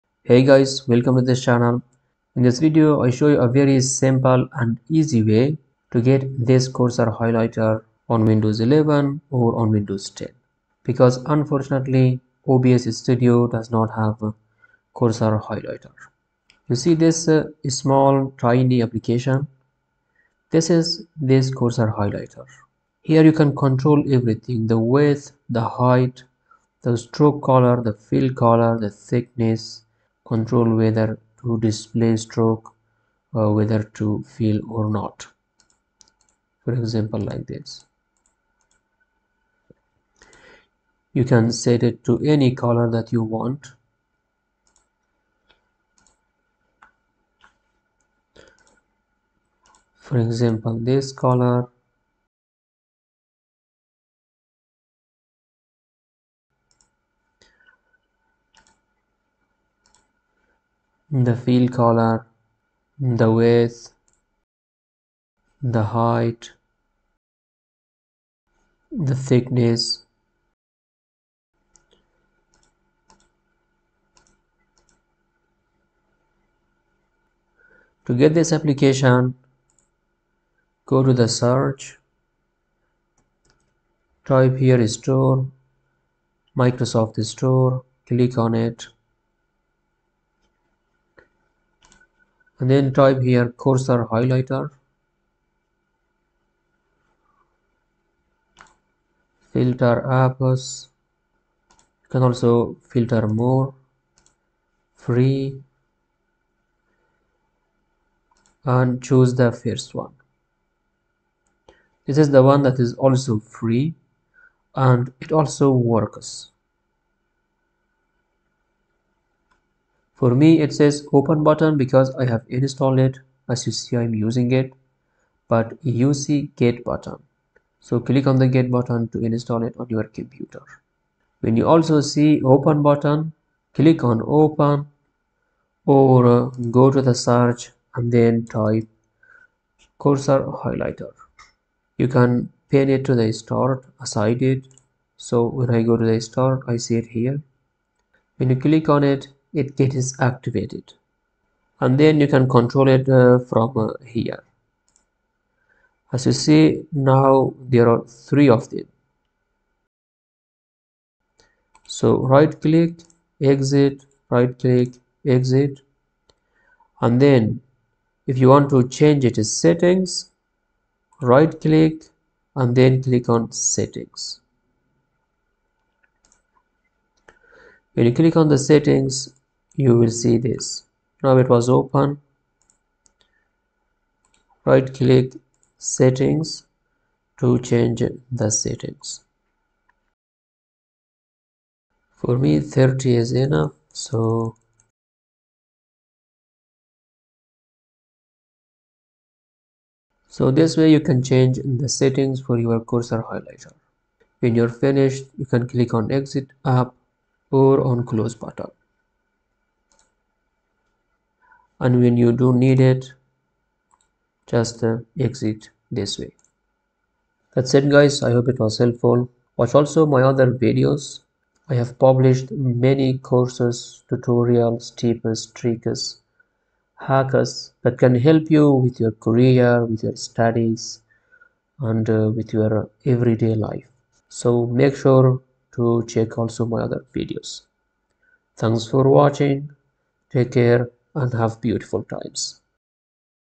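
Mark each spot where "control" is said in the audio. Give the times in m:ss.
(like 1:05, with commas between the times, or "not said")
0:23, 0:30, 2:32.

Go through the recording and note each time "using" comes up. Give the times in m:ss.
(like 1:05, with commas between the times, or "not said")
2:04.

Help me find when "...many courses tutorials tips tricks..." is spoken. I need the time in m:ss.
3:42.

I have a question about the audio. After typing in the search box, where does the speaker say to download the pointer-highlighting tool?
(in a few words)
Microsoft Store.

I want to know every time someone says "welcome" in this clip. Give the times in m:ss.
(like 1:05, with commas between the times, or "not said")
0:00.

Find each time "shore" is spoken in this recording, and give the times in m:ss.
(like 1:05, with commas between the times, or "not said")
not said.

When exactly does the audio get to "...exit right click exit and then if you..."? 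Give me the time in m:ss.
2:43.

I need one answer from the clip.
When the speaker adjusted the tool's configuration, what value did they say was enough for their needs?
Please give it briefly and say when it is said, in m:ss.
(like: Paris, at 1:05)
30, at 3:12.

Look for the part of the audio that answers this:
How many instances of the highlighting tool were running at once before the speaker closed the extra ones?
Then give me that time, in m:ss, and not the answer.
2:38.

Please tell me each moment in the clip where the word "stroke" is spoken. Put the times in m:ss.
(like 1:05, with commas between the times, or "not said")
0:26, 0:32.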